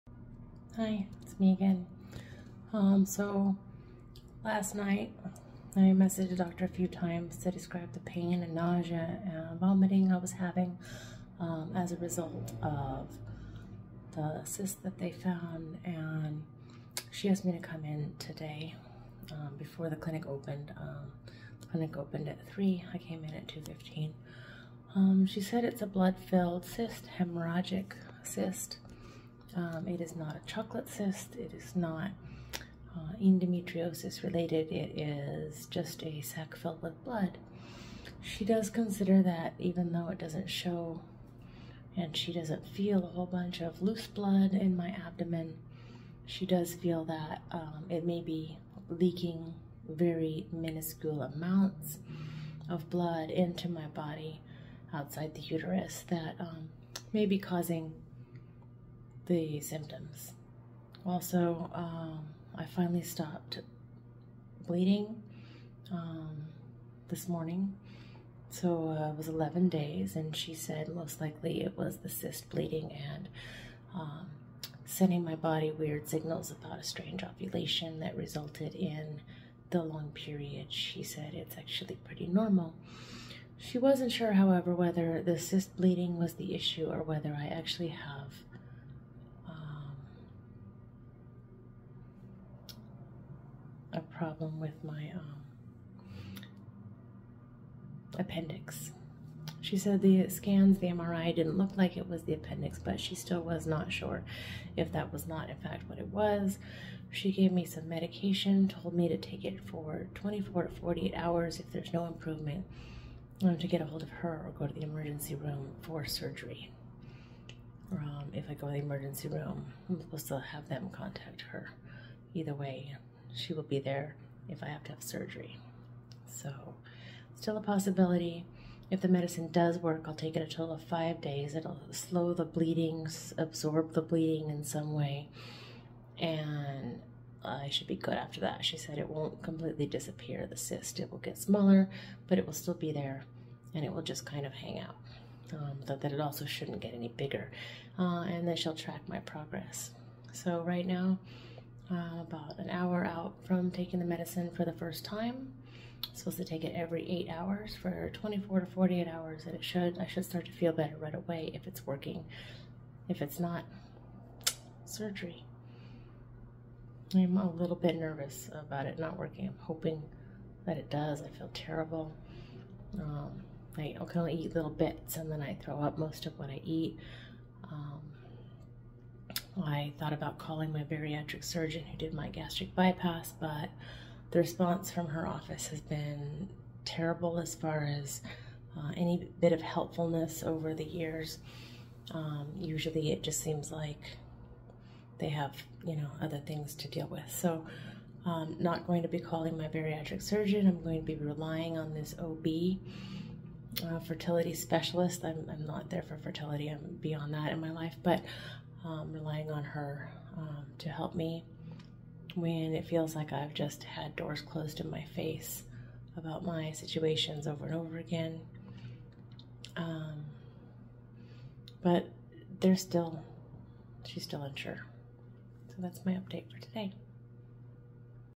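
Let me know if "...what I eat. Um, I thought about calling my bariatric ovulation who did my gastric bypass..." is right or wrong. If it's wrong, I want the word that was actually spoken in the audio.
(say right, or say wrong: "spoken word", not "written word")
wrong: "surgeon", not "ovulation".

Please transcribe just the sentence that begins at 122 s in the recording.
Either way, she will be there if I have to have surgery.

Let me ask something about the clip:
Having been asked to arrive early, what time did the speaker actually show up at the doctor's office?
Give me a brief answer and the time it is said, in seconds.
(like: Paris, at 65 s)
2:15, at 23 s.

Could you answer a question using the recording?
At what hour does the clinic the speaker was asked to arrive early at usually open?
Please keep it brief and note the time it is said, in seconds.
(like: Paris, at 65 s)
3, at 22 s.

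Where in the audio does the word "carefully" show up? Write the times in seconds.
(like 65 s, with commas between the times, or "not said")
not said.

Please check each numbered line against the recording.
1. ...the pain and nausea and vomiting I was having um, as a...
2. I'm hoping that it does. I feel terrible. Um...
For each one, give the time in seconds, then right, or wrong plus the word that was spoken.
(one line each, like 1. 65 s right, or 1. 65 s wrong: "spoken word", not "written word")
1. 7 s right
2. 169 s right.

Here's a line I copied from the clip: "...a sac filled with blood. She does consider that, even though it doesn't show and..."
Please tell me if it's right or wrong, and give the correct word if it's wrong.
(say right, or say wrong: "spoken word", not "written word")
right.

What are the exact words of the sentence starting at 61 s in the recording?
Also, um, I finally stopped bleeding um, this morning.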